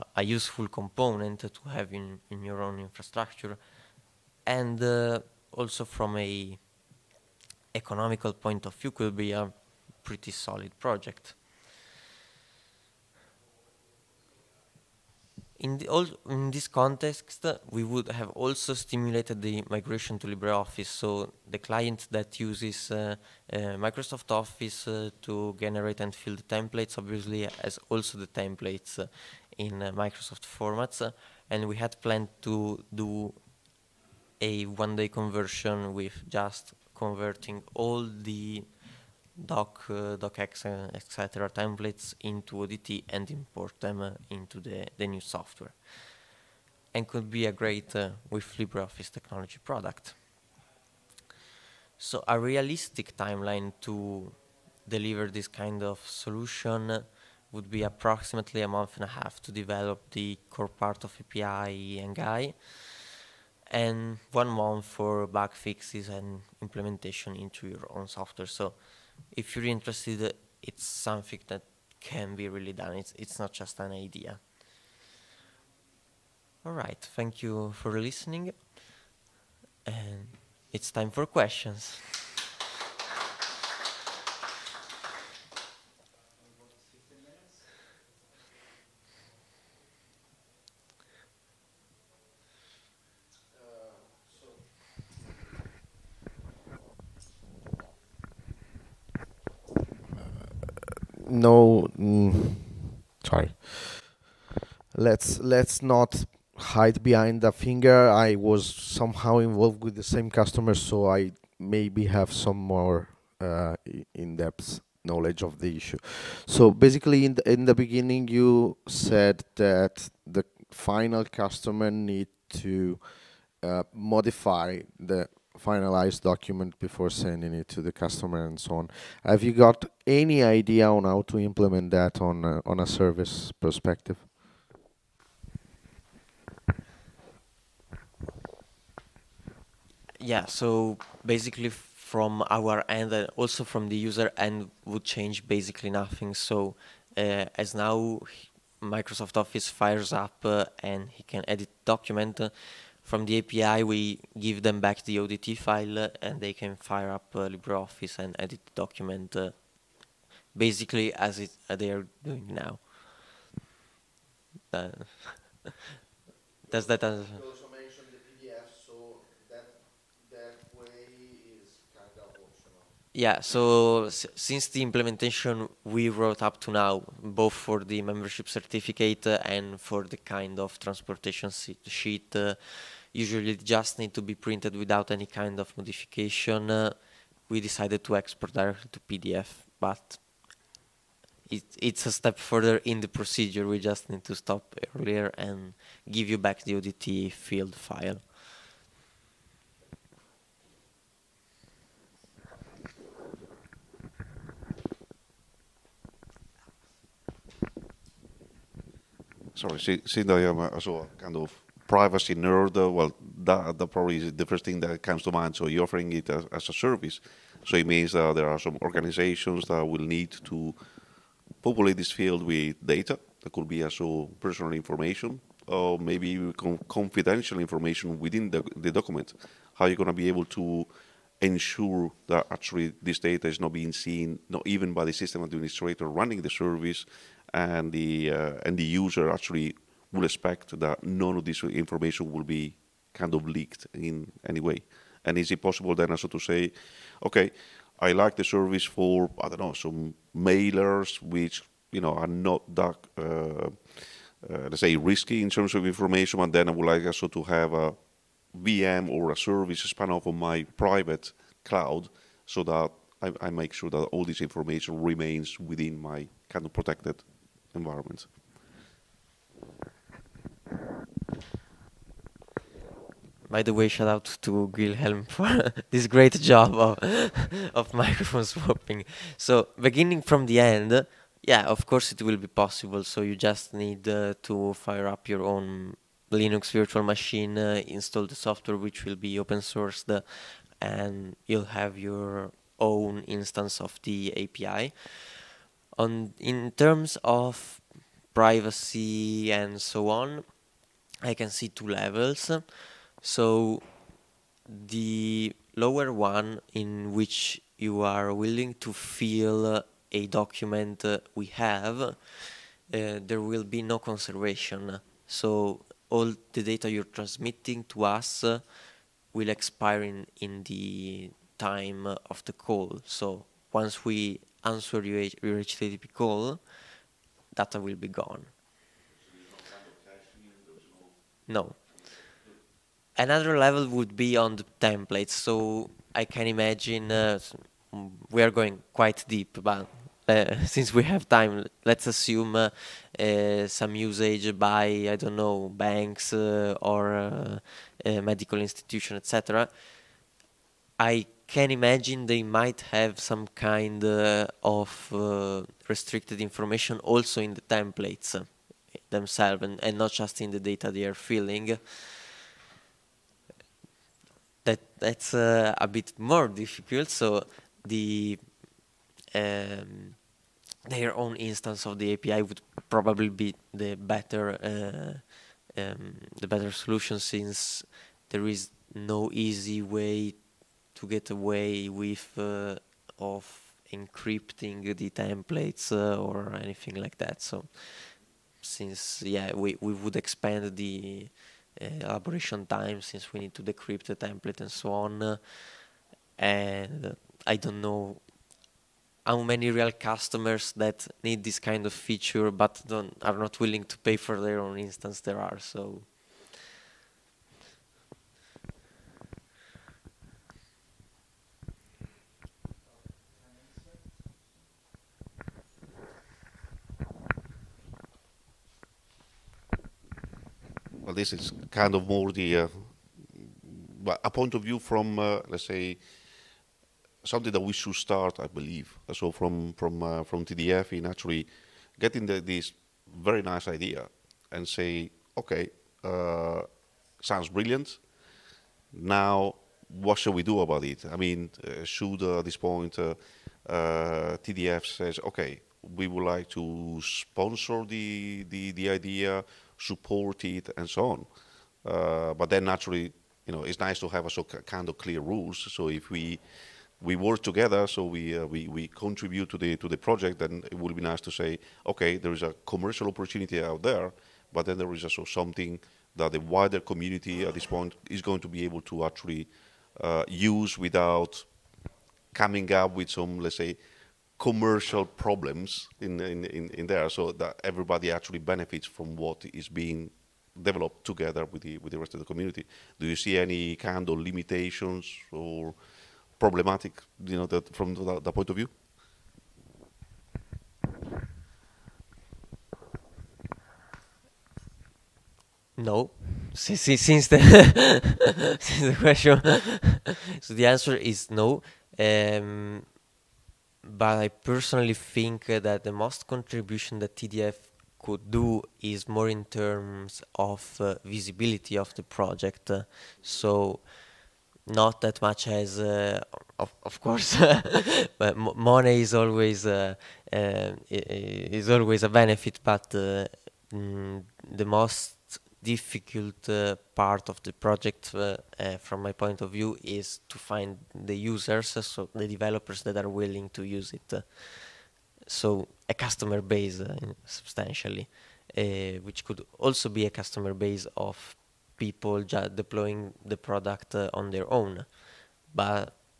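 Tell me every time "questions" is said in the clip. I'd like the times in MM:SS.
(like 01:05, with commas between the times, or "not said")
01:21, 08:18.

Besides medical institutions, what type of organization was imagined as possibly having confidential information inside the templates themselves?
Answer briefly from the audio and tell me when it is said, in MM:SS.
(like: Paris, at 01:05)
Banks, at 05:45.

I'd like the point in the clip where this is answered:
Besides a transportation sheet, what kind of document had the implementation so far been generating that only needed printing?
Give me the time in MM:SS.
02:58.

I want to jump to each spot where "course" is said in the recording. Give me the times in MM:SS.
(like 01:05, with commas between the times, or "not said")
04:41, 08:36.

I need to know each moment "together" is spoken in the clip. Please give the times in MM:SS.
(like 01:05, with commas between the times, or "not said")
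07:37, 08:01.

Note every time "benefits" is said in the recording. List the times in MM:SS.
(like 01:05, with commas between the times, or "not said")
07:58, 08:42.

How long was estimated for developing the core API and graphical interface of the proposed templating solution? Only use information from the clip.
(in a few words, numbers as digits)
A month and a half.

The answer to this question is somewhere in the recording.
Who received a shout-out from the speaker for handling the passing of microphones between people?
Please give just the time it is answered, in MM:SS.
04:34.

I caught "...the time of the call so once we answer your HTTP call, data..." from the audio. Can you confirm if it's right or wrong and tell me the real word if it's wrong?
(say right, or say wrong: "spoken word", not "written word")
right.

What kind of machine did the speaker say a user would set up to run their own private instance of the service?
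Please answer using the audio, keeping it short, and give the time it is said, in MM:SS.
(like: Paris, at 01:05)
Linux virtual machine, at 04:46.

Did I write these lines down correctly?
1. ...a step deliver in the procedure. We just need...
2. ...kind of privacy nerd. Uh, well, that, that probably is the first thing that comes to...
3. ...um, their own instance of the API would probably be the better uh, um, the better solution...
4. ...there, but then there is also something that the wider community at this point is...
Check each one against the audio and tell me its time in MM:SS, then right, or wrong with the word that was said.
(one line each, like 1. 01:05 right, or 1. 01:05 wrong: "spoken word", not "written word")
1. 03:12 wrong: "further", not "deliver"
2. 03:31 right
3. 06:09 right
4. 07:43 right.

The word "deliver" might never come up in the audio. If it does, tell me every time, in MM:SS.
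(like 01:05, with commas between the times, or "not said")
00:54.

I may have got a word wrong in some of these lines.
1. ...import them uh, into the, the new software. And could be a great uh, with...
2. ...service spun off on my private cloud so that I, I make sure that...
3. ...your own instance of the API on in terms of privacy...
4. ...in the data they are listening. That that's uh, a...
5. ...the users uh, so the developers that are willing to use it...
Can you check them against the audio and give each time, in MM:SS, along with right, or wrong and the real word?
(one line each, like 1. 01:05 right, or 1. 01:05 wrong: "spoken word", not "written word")
1. 00:43 right
2. 04:19 right
3. 04:51 right
4. 06:00 wrong: "filling", not "listening"
5. 08:50 right.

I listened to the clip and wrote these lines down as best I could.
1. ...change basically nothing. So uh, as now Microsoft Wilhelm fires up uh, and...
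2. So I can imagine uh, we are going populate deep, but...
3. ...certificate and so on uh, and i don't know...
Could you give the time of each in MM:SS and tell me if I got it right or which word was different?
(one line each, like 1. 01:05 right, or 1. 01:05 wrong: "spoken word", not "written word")
1. 02:25 wrong: "Office", not "Wilhelm"
2. 05:35 wrong: "quite", not "populate"
3. 06:34 wrong: "template", not "certificate".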